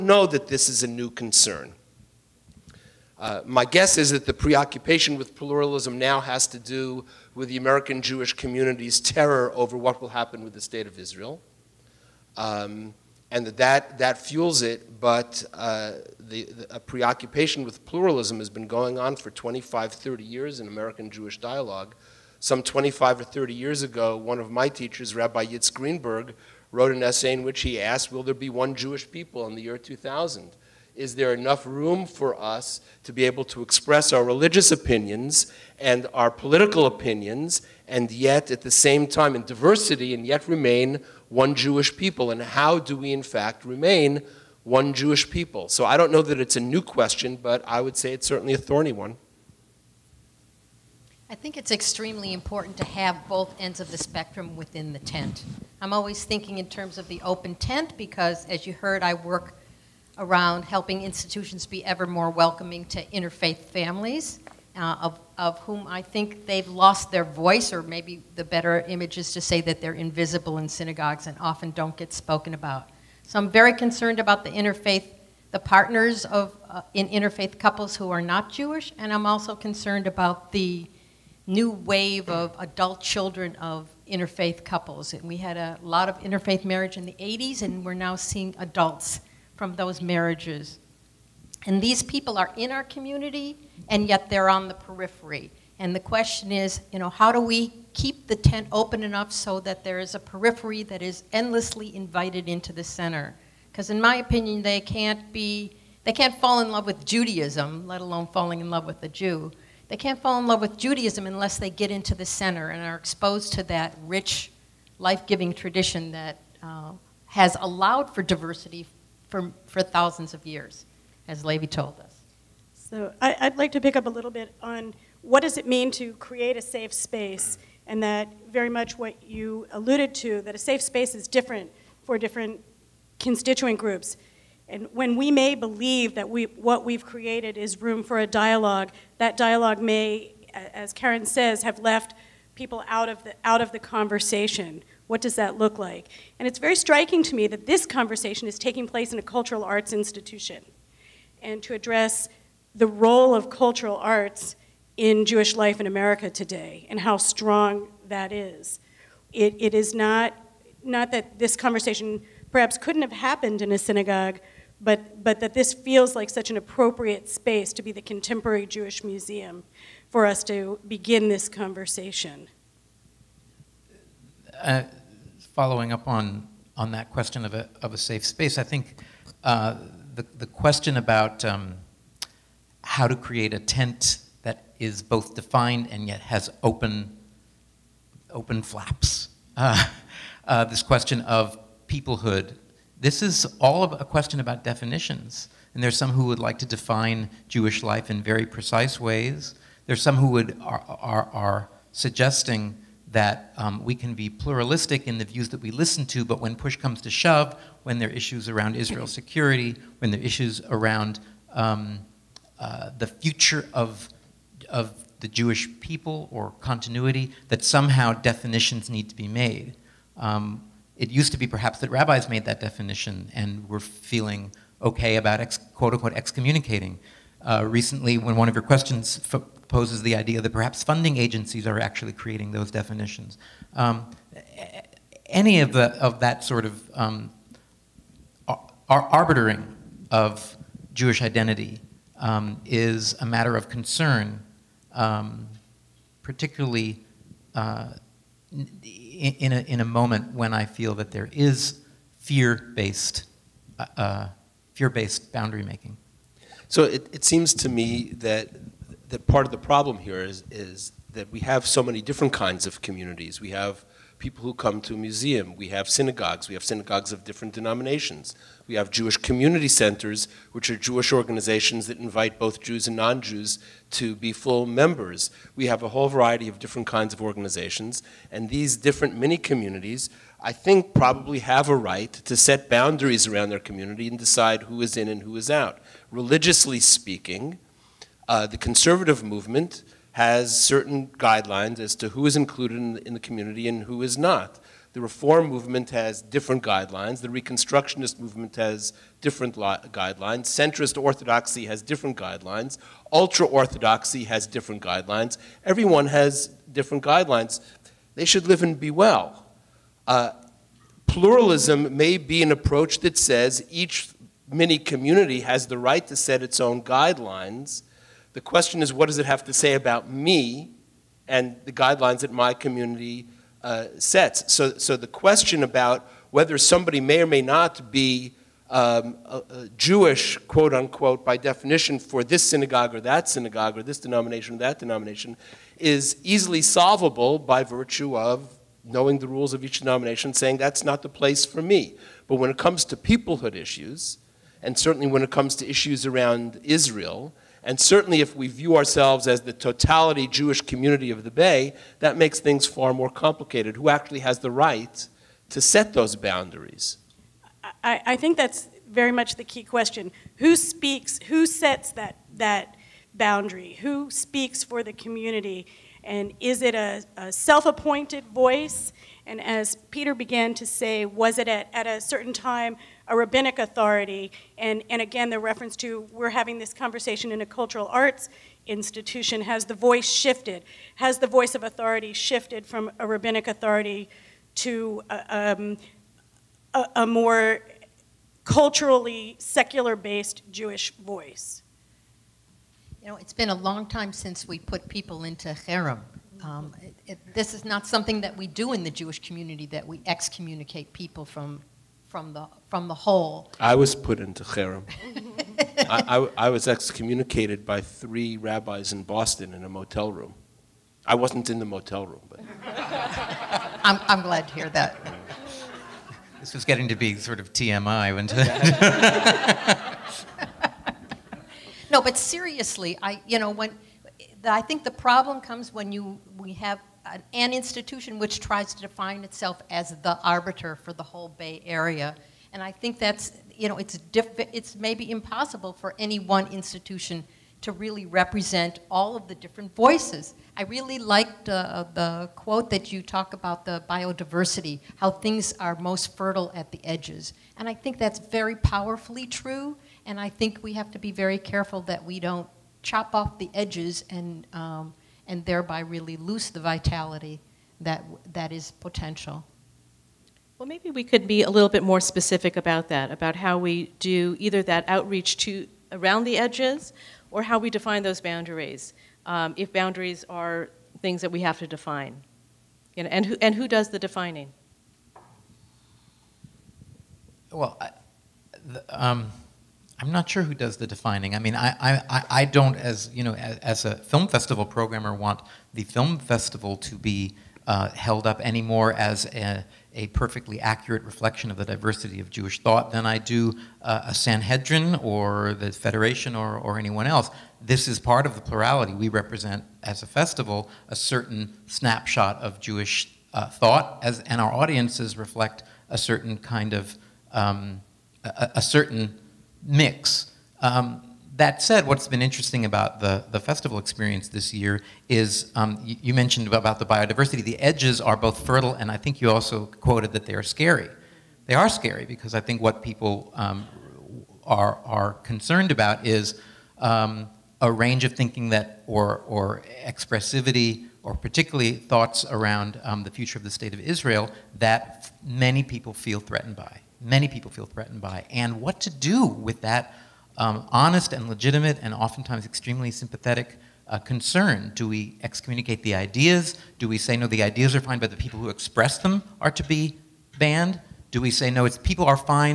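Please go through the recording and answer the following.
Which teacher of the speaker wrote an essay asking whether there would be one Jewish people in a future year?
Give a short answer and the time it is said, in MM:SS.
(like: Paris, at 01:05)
Rabbi Yitz Greenberg, at 00:25.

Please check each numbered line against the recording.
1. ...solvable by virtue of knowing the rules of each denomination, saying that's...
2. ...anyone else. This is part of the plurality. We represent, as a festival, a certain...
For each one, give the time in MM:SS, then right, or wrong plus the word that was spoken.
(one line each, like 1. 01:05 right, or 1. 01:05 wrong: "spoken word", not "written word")
1. 05:36 right
2. 08:16 right.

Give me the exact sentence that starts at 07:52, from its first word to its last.
You know, and, who, and who does the defining?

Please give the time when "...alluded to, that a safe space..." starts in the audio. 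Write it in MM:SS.
02:09.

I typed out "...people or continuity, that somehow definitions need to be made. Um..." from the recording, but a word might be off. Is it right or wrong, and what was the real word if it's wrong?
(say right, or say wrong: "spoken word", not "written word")
right.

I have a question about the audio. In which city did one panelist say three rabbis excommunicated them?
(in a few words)
Boston.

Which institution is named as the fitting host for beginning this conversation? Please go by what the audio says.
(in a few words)
The Contemporary Jewish Museum.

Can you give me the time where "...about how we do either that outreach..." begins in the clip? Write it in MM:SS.
07:43.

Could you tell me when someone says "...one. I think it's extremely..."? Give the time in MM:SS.
00:48.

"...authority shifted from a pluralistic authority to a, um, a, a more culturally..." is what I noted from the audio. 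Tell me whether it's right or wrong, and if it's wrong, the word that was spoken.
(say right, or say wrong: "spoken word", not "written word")
wrong: "rabbinic", not "pluralistic".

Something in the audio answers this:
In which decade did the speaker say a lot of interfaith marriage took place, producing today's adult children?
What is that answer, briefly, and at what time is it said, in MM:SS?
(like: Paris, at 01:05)
1980s, at 01:27.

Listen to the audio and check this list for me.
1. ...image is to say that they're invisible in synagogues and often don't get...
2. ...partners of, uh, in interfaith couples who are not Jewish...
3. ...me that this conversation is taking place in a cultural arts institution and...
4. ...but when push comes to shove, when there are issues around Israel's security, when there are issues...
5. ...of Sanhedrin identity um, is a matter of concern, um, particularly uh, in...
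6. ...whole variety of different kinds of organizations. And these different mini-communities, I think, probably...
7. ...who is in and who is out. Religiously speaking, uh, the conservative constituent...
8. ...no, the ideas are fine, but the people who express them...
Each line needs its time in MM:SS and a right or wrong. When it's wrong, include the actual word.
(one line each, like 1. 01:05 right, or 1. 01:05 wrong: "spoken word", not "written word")
1. 01:08 right
2. 01:15 right
3. 02:27 right
4. 03:26 right
5. 04:00 wrong: "Jewish", not "Sanhedrin"
6. 04:35 right
7. 04:44 wrong: "movement", not "constituent"
8. 09:07 right.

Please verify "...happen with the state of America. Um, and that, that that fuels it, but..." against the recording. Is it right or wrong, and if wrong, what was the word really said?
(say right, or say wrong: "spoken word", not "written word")
wrong: "Israel", not "America".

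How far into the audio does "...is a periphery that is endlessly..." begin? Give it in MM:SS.
01:39.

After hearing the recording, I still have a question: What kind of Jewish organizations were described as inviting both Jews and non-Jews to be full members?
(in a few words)
Jewish community centers.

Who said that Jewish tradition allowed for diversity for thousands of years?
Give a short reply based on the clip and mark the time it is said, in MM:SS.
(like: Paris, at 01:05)
Lavey, at 02:01.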